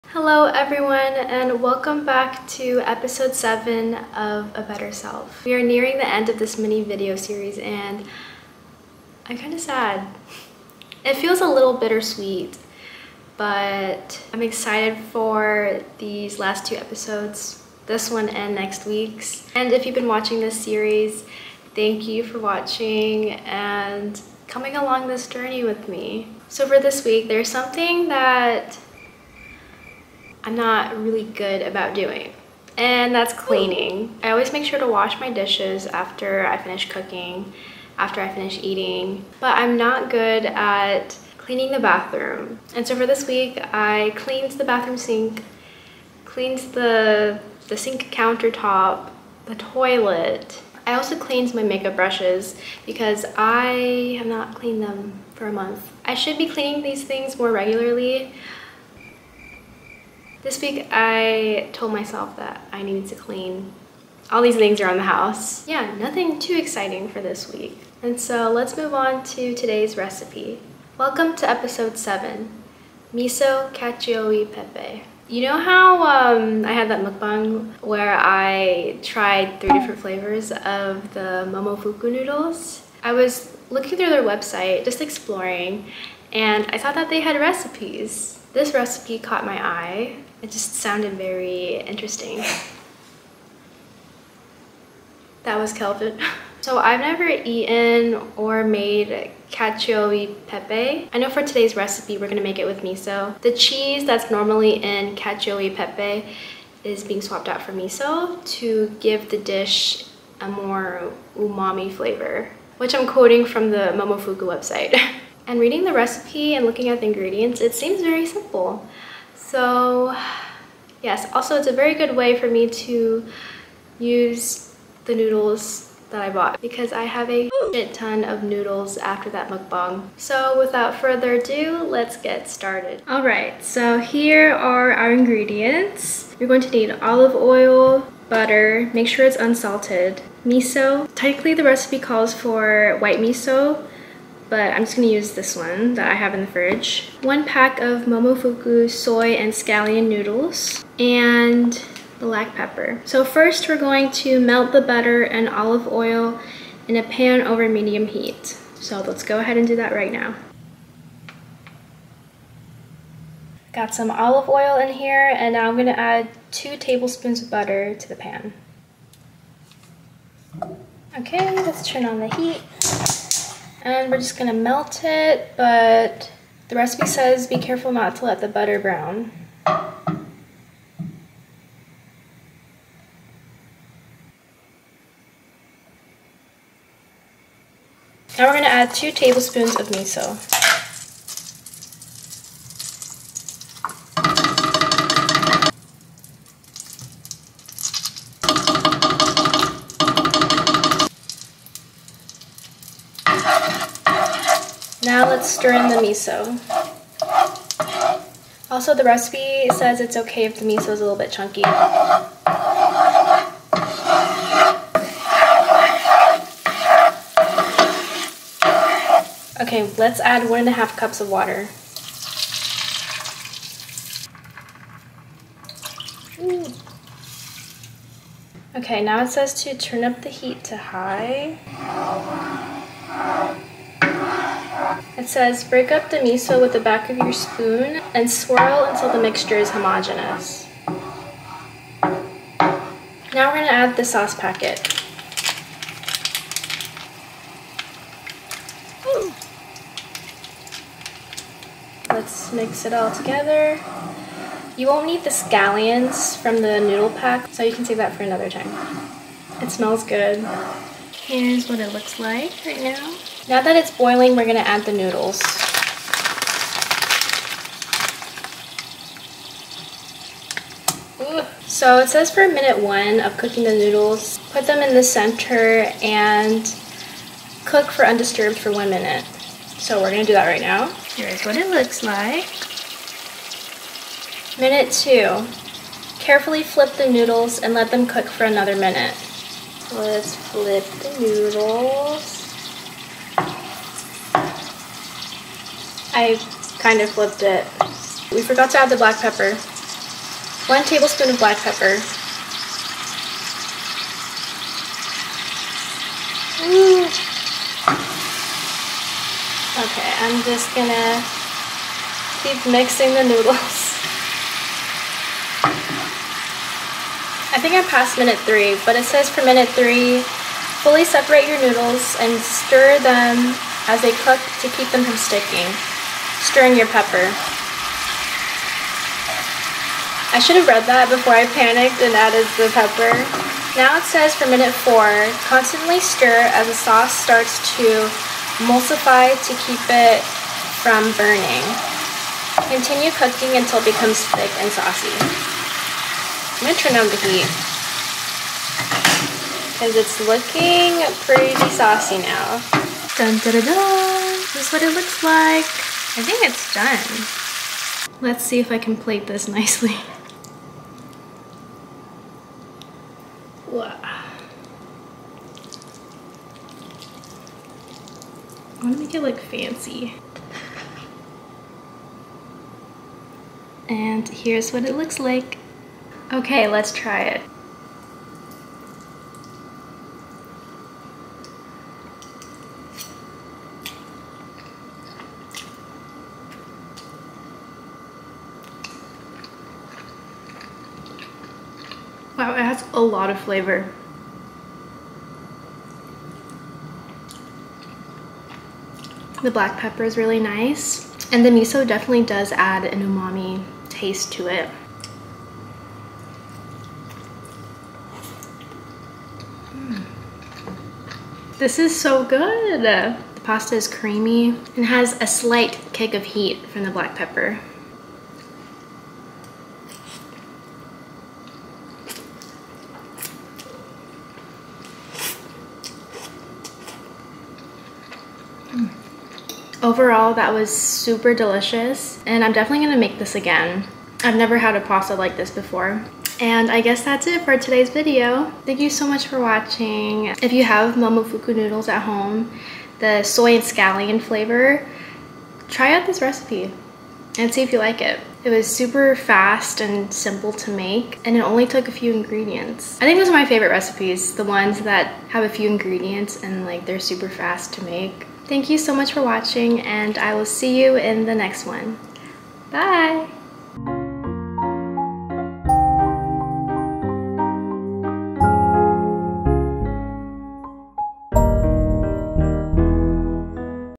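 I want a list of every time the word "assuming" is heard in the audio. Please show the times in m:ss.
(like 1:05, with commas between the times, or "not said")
not said.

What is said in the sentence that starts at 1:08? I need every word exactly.
And so let's move on to today's recipe.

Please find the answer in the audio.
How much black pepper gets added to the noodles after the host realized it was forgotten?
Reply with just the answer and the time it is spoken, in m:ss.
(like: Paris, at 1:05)
1 tablespoon, at 5:00.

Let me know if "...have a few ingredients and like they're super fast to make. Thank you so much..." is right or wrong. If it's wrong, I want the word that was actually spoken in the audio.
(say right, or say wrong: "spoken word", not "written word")
right.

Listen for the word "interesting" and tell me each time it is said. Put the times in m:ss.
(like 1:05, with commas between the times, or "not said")
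1:31.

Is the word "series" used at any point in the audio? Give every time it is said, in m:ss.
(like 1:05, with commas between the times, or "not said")
0:07, 0:20.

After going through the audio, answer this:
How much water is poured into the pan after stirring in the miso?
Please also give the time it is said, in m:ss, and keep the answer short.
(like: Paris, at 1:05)
1.5 cups, at 3:40.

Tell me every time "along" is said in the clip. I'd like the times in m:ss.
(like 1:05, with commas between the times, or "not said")
0:24.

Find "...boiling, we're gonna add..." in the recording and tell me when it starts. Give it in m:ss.
4:23.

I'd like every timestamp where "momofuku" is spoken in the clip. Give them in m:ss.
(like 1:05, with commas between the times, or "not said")
1:21, 1:53, 2:28, 7:20.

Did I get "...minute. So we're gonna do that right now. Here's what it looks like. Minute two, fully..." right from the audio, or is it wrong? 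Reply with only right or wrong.
wrong.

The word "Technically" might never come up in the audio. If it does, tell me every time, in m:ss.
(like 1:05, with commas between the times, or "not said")
2:21.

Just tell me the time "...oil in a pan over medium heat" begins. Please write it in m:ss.
2:35.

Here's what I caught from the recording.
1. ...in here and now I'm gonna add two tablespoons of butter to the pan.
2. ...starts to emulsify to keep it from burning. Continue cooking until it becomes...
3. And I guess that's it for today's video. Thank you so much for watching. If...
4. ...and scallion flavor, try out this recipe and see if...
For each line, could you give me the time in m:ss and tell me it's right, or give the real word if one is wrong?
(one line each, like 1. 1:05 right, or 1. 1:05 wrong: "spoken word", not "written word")
1. 2:44 right
2. 5:37 right
3. 7:16 right
4. 7:23 right.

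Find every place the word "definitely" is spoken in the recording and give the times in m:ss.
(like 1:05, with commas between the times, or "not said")
6:41, 7:12.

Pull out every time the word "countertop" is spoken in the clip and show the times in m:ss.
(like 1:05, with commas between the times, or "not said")
0:48.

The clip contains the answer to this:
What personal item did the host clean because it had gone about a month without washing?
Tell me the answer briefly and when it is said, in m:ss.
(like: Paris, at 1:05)
makeup brushes, at 0:51.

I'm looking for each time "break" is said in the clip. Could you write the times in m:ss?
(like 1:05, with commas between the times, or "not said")
3:55.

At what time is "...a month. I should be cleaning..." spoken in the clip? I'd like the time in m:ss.
0:55.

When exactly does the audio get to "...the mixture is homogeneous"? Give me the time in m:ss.
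3:59.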